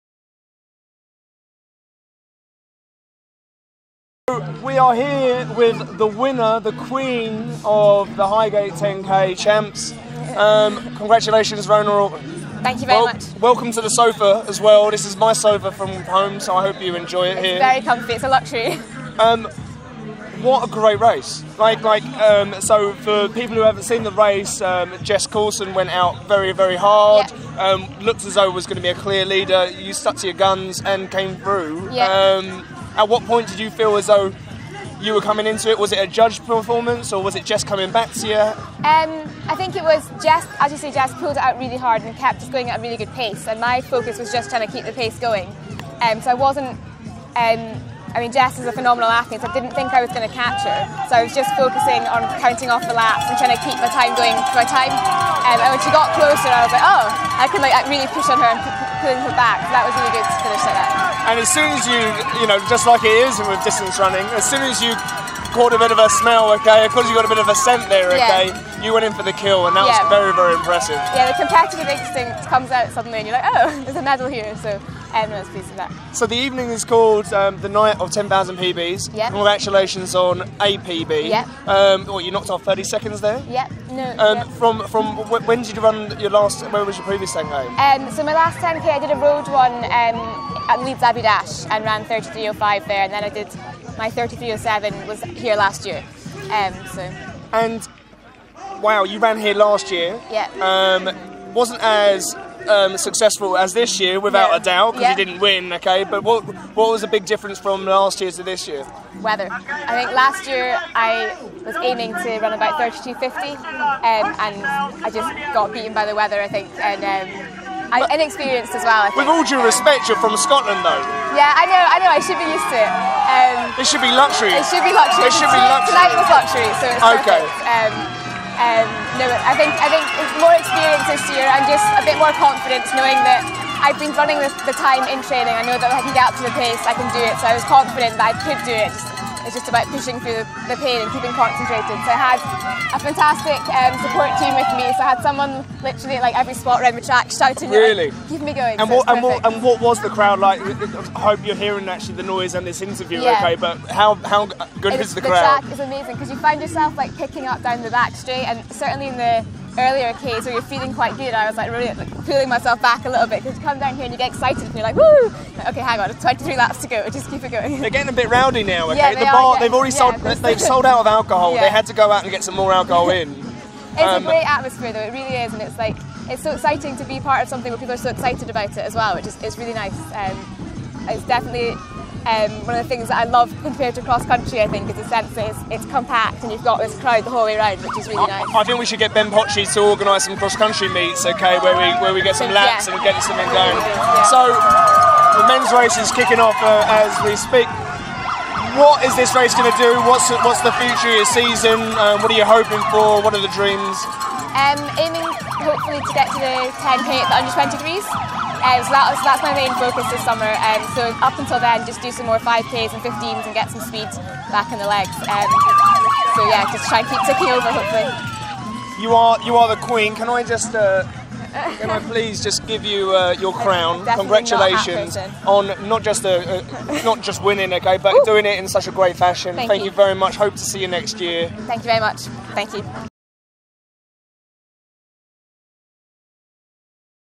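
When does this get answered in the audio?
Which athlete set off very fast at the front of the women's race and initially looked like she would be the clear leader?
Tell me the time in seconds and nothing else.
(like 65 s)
25 s.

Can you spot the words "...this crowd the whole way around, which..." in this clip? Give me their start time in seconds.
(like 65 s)
186 s.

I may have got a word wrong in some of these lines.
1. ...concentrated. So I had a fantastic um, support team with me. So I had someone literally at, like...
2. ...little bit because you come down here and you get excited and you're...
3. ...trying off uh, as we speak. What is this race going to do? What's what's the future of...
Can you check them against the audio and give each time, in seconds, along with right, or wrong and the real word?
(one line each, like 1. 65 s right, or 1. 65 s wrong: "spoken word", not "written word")
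1. 141 s right
2. 163 s right
3. 196 s wrong: "kicking", not "trying".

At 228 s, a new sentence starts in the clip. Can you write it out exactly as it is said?
doing it in such a great fashion.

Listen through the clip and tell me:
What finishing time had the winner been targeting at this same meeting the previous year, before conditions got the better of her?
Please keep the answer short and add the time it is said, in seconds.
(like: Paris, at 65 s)
32:50, at 112 s.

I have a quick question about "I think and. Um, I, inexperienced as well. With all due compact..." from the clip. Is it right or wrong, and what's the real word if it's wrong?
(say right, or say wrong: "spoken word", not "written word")
wrong: "respect", not "compact".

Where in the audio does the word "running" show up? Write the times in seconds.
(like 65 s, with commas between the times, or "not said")
63 s, 134 s.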